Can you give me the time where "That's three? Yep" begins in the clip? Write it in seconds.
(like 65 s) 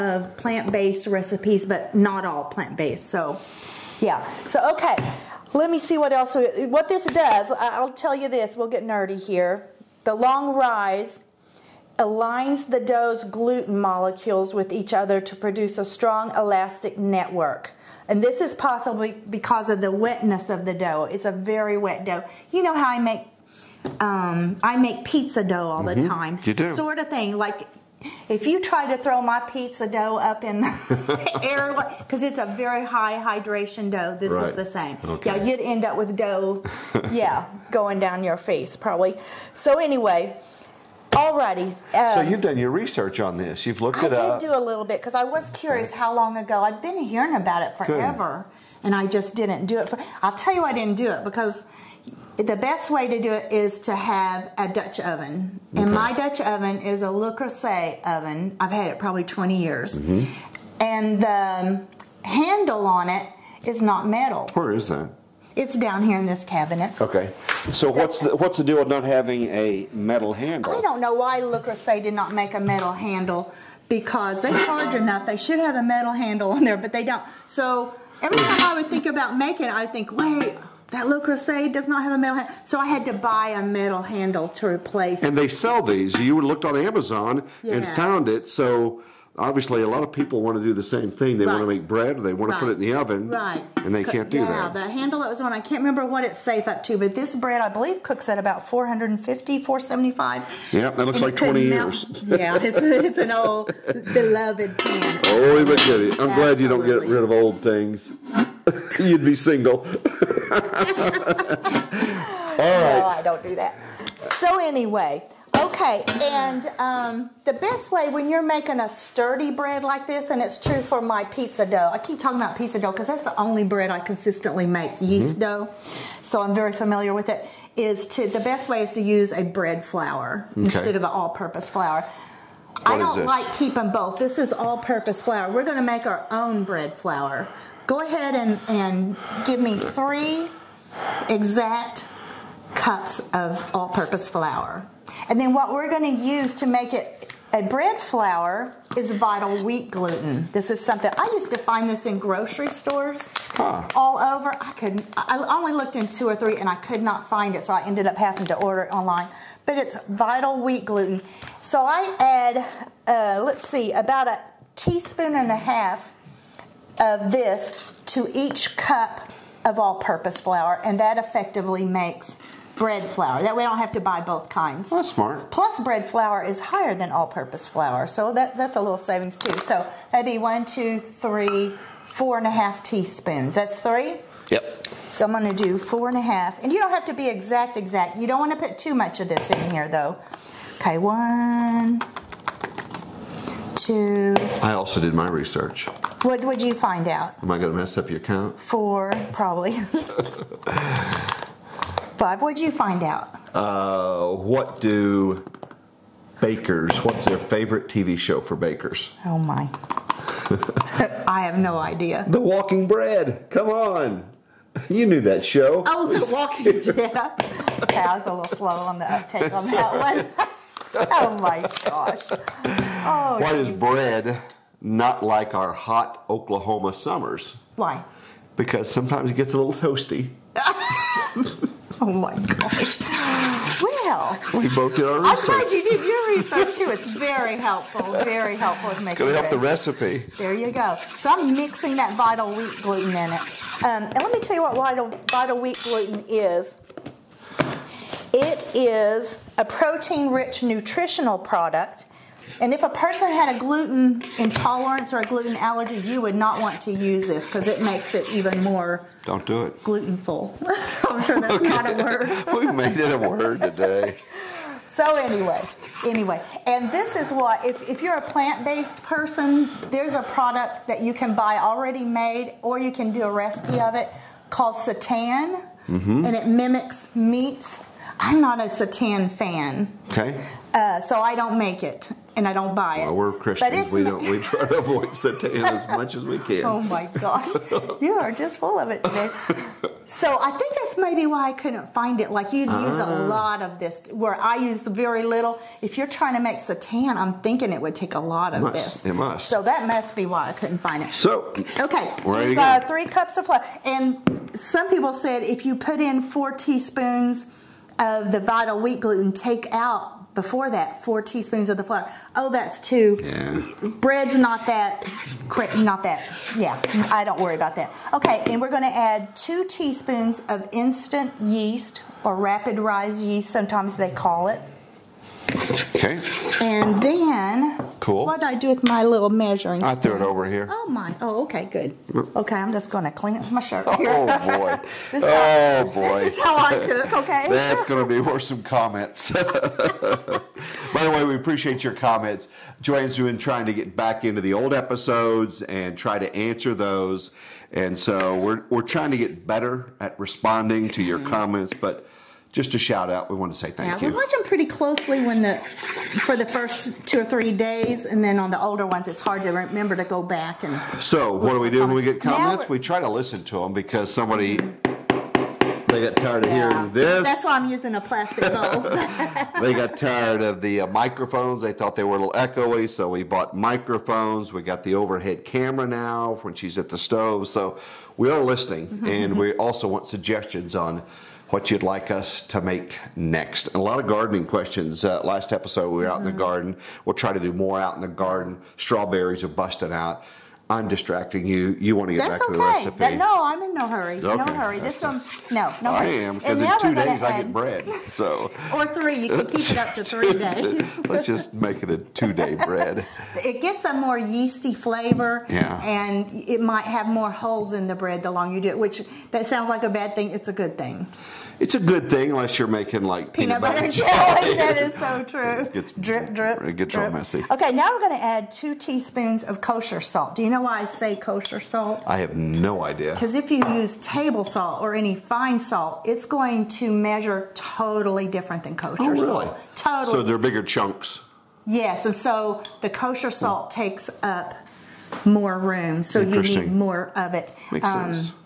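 183 s.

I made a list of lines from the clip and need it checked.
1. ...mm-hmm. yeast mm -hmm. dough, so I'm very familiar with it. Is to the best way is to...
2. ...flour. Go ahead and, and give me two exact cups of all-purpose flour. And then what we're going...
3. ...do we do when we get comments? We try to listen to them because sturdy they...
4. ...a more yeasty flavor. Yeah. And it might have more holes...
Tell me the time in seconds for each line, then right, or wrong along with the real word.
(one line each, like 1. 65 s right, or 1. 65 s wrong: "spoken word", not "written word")
1. 124 s right
2. 137 s wrong: "three", not "two"
3. 361 s wrong: "somebody", not "sturdy"
4. 403 s right.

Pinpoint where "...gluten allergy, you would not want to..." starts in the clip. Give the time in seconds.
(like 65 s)
255 s.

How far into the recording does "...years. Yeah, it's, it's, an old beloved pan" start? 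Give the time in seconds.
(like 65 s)
101 s.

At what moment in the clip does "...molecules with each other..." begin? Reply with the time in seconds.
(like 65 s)
13 s.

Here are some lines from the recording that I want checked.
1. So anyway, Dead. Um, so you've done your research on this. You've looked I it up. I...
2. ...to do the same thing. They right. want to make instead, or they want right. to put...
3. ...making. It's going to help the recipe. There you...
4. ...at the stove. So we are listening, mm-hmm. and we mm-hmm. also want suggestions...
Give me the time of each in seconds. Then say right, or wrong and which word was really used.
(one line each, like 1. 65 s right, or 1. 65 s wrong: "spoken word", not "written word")
1. 39 s wrong: "Alrighty", not "Dead"
2. 90 s wrong: "bread", not "instead"
3. 238 s right
4. 376 s right.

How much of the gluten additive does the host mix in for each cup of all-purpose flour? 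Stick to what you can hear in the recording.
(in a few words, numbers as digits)
1.5 teaspoons.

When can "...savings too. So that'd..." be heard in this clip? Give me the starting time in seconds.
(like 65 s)
178 s.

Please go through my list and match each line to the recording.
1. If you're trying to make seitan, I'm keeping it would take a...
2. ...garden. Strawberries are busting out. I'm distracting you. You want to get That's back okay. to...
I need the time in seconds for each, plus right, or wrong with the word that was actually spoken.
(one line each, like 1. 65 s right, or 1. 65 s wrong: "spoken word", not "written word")
1. 295 s wrong: "thinking", not "keeping"
2. 388 s right.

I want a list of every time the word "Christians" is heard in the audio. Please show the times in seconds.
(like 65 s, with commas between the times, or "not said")
283 s.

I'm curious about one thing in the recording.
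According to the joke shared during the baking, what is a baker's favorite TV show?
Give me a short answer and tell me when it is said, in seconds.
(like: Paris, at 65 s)
The Walking Bread, at 212 s.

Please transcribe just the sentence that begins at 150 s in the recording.
This is something I used to find this in grocery stores huh.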